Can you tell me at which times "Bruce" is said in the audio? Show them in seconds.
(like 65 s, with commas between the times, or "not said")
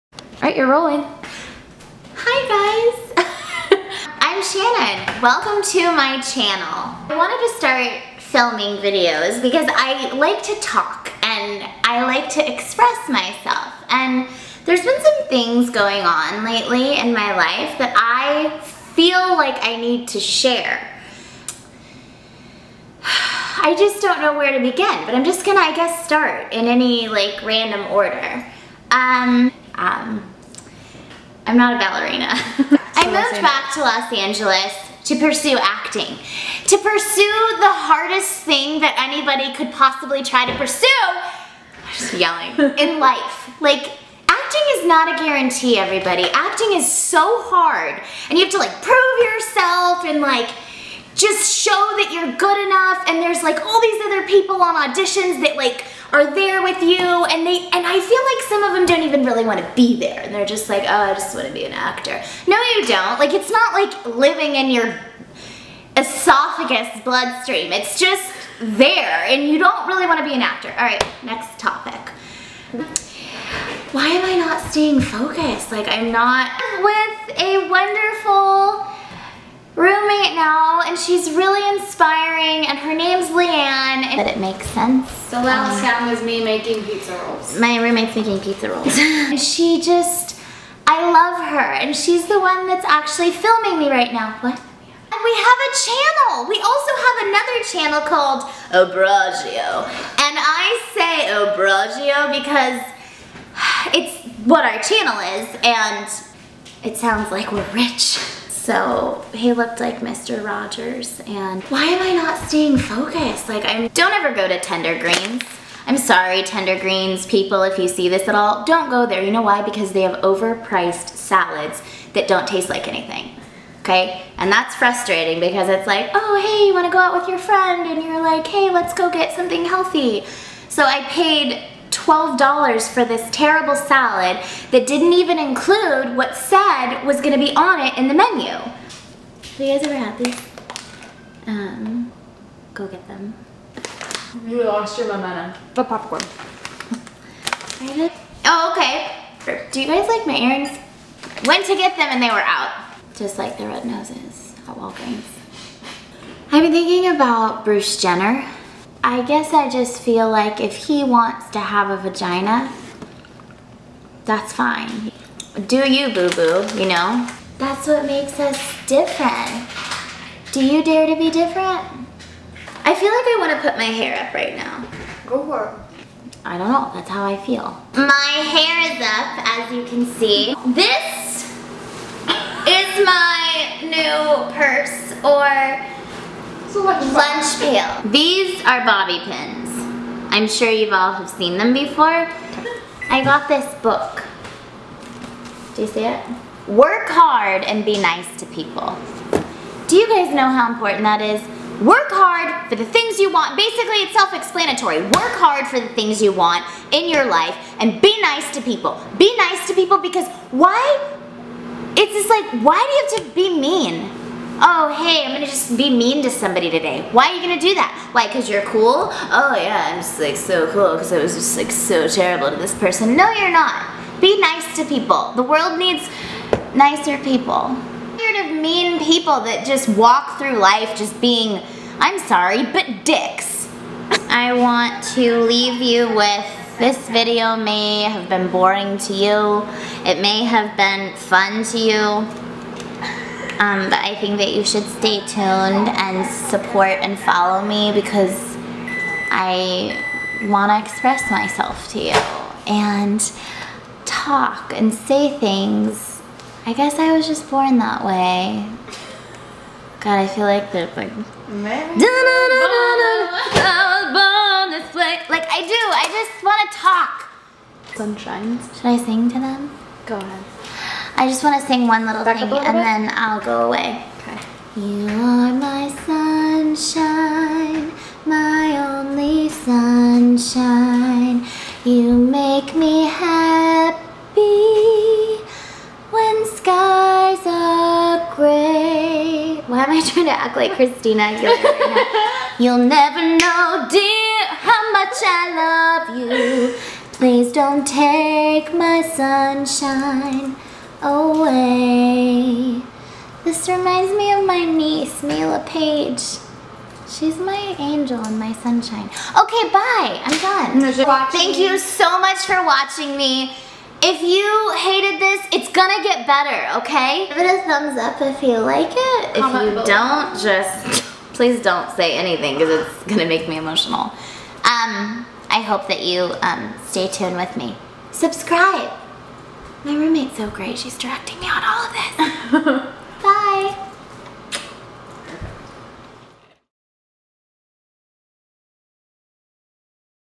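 157 s.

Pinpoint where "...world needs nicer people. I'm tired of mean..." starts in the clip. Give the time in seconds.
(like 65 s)
225 s.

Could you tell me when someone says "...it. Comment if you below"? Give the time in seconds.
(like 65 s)
318 s.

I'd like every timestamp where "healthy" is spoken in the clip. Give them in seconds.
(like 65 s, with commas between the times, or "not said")
129 s.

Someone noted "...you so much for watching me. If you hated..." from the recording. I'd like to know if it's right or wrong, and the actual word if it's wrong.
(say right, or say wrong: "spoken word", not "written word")
right.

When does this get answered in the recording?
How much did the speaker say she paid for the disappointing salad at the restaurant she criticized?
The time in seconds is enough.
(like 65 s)
132 s.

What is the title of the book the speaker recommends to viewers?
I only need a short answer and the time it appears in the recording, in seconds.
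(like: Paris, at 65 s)
Work hard and be nice to people, at 196 s.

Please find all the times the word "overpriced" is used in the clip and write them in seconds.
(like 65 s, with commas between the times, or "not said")
120 s.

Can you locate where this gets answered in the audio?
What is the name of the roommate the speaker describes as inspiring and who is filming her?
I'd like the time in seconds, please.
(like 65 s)
83 s.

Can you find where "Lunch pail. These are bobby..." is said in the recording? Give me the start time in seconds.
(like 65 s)
187 s.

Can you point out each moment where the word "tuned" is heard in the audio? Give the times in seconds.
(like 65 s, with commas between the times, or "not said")
245 s, 327 s.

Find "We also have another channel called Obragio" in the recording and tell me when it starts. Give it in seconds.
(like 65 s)
96 s.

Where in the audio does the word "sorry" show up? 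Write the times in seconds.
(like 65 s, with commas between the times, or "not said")
115 s, 232 s.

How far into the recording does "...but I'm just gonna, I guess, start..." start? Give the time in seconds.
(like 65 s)
25 s.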